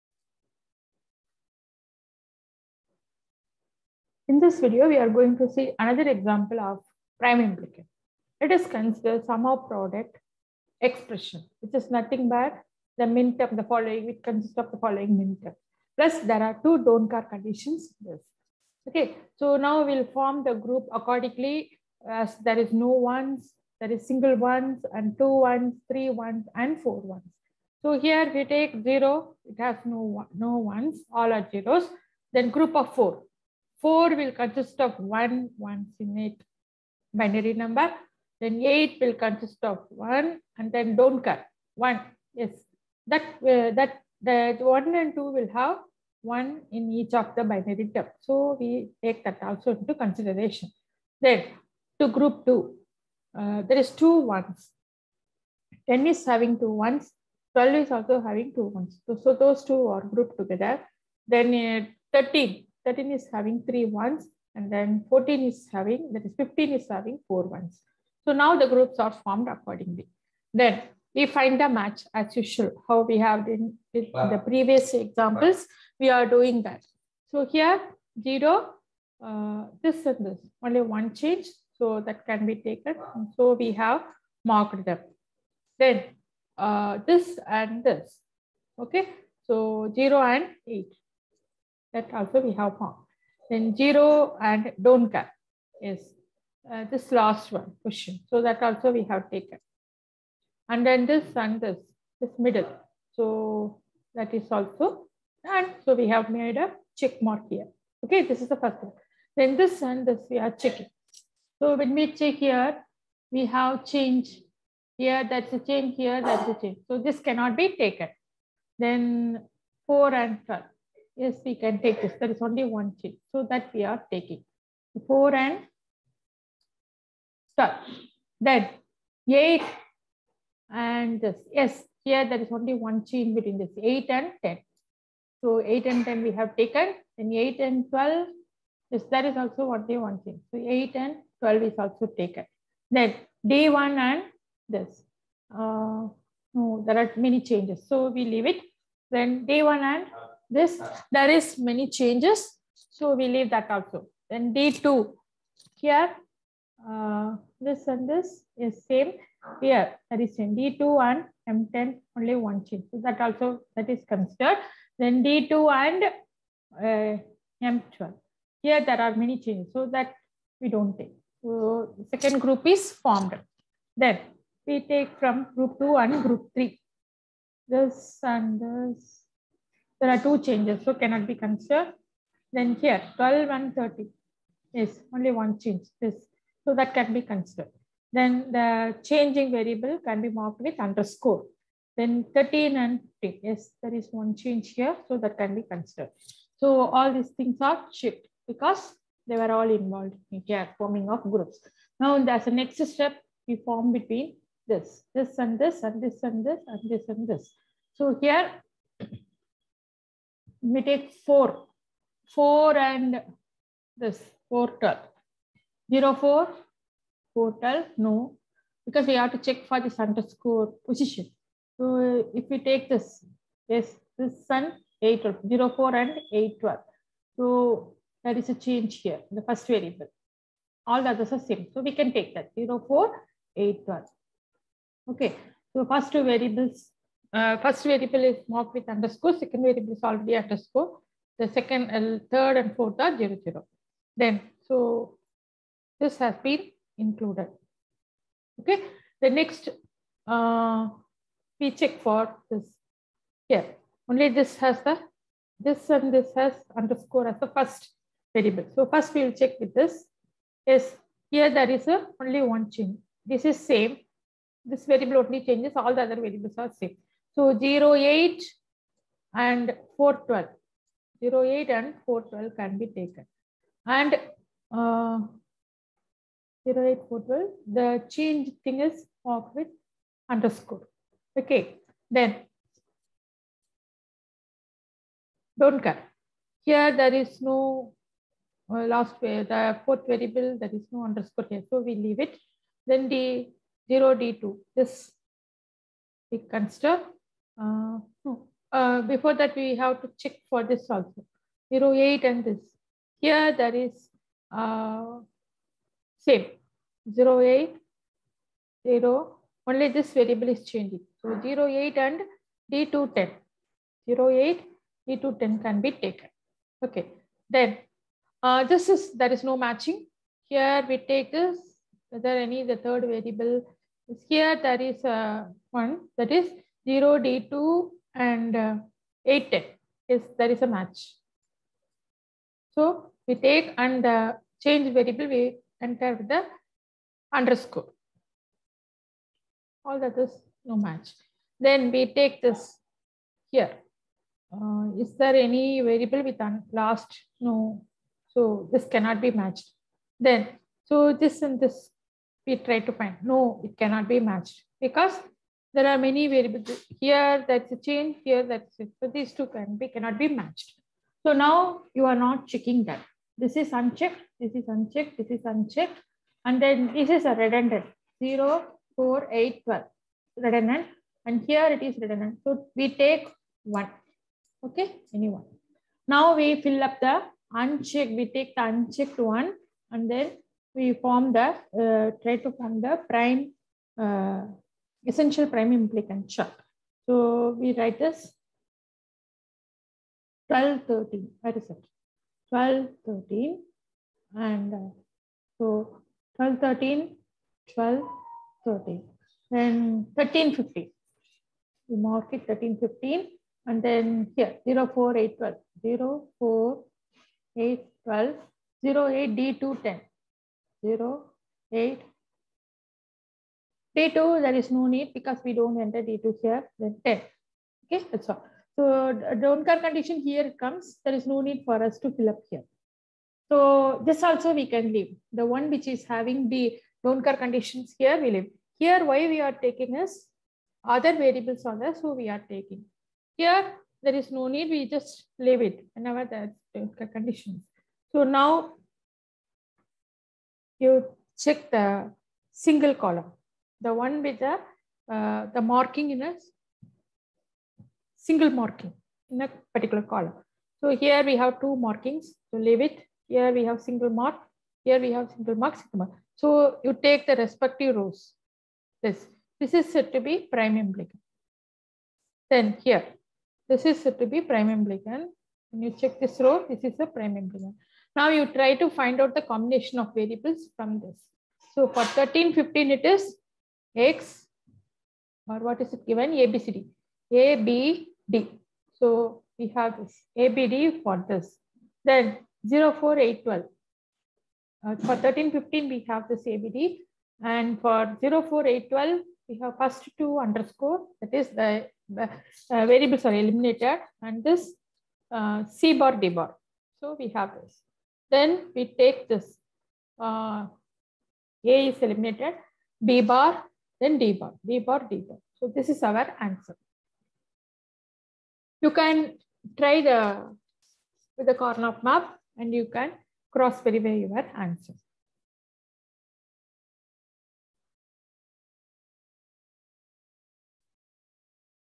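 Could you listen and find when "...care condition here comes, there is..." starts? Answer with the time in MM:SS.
06:59.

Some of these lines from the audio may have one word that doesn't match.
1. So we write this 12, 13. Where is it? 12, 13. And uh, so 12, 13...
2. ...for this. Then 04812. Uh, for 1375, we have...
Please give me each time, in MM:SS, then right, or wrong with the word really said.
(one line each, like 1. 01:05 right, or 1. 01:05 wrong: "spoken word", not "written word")
1. 06:27 right
2. 08:01 wrong: "1315", not "1375".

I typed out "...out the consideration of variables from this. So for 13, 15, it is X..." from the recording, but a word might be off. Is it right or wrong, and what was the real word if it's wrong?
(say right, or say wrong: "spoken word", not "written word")
wrong: "combination", not "consideration".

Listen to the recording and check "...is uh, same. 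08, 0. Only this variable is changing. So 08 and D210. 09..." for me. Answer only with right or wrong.
wrong.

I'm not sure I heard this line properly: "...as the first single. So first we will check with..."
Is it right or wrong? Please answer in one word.
wrong.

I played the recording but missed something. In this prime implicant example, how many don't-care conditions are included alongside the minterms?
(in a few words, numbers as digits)
2.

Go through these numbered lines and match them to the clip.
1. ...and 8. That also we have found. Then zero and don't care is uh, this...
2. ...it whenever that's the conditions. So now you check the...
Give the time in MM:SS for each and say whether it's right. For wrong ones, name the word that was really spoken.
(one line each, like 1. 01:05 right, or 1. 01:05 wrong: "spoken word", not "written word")
1. 01:30 right
2. 07:15 right.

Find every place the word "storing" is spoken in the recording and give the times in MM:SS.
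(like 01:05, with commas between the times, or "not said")
not said.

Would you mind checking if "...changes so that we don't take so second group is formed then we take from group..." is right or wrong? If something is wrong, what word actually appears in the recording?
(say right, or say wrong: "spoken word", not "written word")
right.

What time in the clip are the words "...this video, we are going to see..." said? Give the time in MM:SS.
00:04.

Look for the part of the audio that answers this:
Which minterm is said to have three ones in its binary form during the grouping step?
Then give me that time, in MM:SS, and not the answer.
01:02.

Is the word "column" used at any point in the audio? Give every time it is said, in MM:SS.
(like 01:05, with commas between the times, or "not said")
07:22, 07:30.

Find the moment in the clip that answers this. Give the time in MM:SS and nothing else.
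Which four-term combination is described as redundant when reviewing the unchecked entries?
06:08.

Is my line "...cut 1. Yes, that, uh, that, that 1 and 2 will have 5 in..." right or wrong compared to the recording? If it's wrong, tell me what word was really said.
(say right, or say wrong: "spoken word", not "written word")
wrong: "1", not "5".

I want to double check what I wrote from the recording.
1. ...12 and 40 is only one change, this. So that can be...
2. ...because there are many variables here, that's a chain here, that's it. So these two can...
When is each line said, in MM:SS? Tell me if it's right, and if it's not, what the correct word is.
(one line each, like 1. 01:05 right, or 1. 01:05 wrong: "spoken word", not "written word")
1. 03:03 wrong: "30", not "40"
2. 05:54 right.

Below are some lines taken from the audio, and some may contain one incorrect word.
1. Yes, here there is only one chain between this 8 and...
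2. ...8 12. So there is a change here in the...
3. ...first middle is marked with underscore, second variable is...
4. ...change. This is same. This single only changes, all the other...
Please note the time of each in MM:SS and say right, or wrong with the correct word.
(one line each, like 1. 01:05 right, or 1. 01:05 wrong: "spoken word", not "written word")
1. 02:11 right
2. 03:46 right
3. 03:57 wrong: "variable", not "middle"
4. 04:22 wrong: "variable", not "single".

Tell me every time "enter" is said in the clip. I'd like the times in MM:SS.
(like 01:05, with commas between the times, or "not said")
05:35, 06:55.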